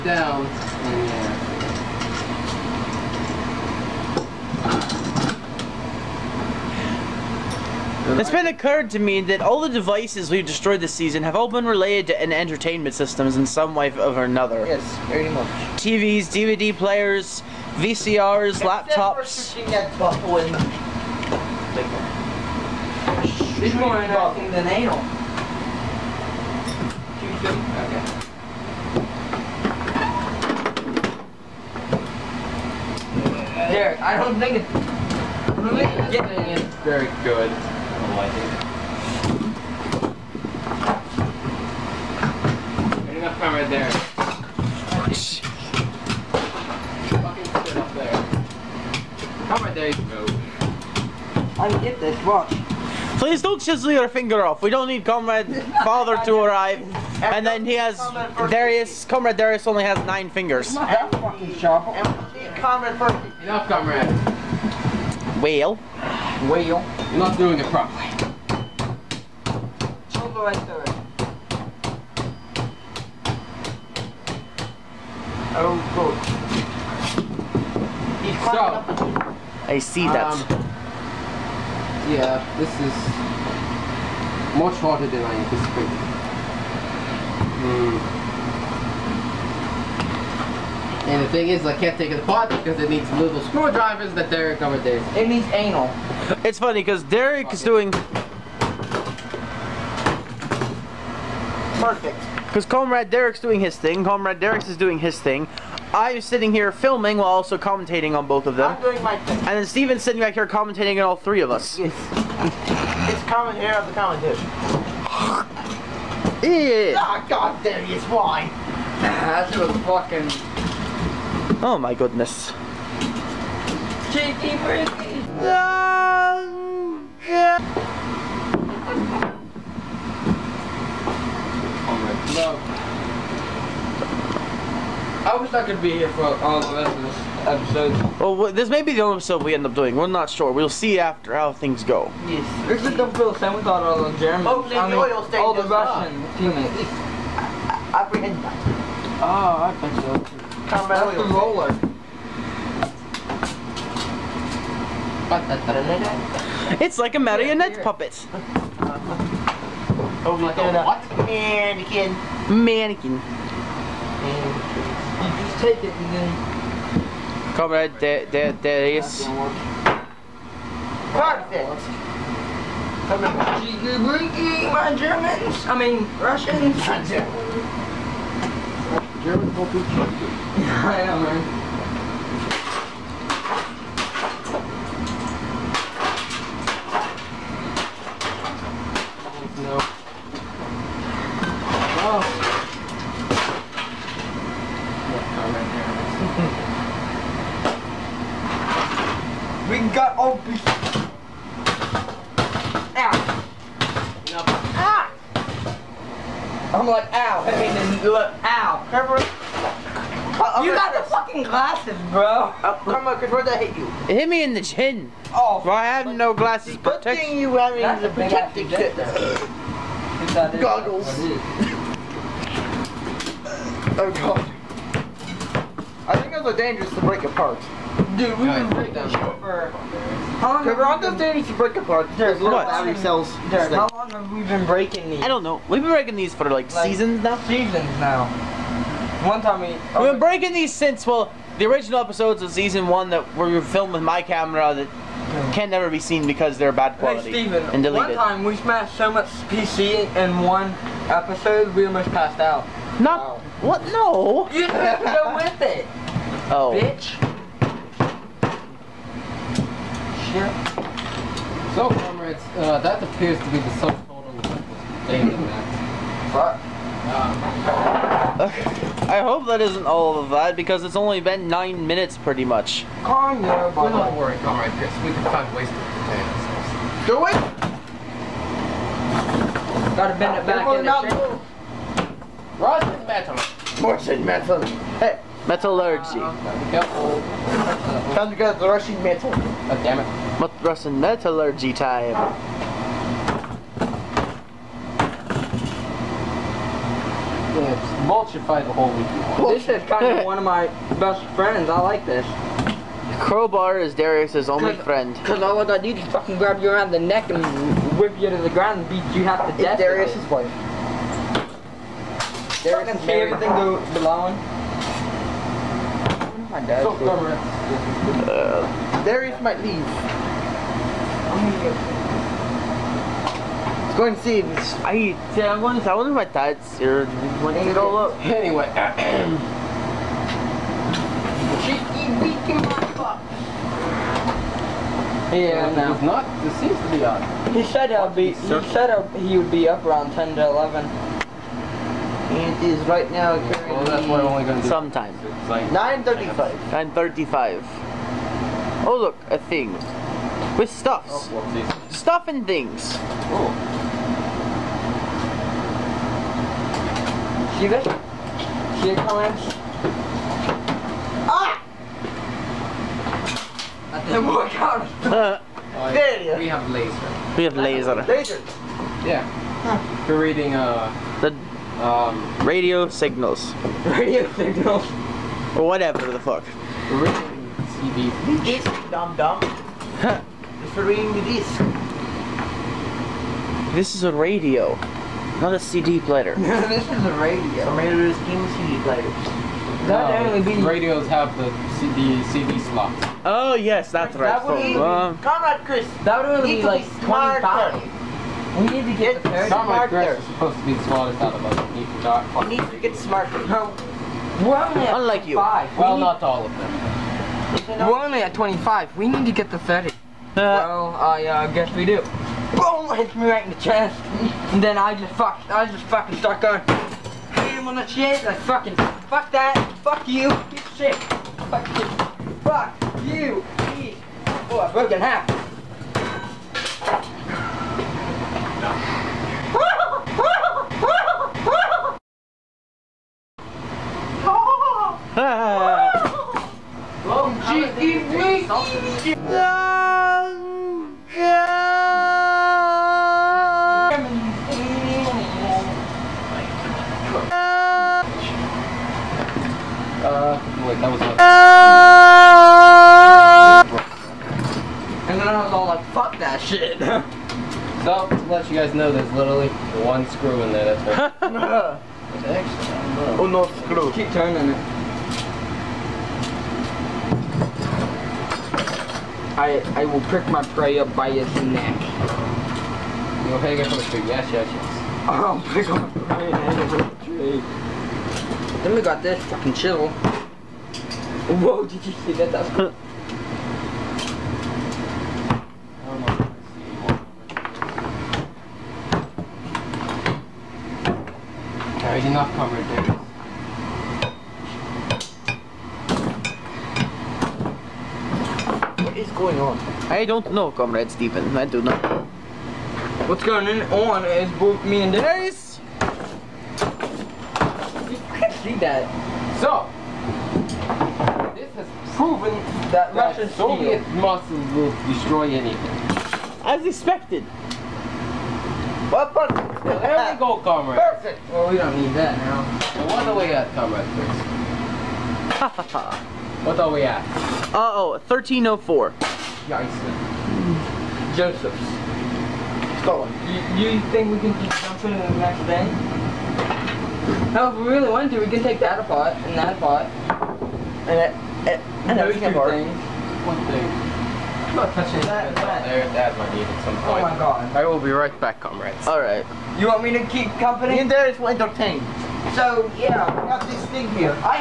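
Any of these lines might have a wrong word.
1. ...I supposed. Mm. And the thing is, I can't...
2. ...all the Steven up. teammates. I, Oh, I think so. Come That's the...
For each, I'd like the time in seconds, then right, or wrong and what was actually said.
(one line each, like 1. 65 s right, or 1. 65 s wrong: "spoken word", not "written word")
1. 85 s wrong: "anticipated", not "supposed"
2. 145 s wrong: "Russian", not "Steven".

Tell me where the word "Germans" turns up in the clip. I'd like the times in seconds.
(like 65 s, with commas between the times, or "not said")
144 s, 174 s, 179 s.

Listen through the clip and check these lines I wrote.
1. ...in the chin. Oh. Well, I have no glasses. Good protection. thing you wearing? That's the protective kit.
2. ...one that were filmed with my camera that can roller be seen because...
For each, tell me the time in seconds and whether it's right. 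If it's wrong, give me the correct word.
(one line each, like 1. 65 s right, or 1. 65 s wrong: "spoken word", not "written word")
1. 214 s right
2. 242 s wrong: "never", not "roller".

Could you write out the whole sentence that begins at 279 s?
Gotta bend it back in the Russian metal.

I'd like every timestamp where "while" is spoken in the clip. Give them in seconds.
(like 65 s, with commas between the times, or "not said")
107 s.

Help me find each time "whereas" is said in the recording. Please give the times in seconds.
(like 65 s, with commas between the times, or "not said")
not said.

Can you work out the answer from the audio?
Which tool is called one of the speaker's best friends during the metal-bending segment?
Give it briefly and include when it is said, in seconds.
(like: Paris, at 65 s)
Crowbar, at 303 s.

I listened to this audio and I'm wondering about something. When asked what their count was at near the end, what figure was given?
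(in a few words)
1304.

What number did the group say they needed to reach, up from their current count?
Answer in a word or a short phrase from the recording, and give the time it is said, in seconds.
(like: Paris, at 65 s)
30, at 409 s.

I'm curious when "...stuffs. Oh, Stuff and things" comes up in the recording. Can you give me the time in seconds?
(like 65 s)
350 s.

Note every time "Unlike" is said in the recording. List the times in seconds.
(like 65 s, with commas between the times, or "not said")
404 s.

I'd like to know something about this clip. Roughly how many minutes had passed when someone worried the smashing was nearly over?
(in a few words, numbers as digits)
9.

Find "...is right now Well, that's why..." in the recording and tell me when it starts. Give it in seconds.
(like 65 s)
342 s.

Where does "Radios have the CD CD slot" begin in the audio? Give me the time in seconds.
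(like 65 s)
390 s.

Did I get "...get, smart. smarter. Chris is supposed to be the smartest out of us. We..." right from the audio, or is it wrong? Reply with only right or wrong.
right.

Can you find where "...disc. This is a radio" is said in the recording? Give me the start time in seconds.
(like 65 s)
381 s.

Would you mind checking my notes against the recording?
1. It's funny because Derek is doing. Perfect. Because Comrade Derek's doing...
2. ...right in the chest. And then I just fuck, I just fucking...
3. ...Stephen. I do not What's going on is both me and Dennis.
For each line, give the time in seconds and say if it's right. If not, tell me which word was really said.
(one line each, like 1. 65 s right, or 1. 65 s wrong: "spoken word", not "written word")
1. 96 s right
2. 413 s right
3. 500 s right.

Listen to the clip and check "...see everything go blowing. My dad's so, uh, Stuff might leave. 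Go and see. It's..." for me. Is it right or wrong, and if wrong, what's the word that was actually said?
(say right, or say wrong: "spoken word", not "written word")
wrong: "Darius", not "Stuff".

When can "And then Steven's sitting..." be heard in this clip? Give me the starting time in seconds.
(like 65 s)
109 s.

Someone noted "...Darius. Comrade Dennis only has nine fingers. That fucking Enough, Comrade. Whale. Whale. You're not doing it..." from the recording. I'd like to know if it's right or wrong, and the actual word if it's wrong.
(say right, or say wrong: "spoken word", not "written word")
wrong: "Darius", not "Dennis".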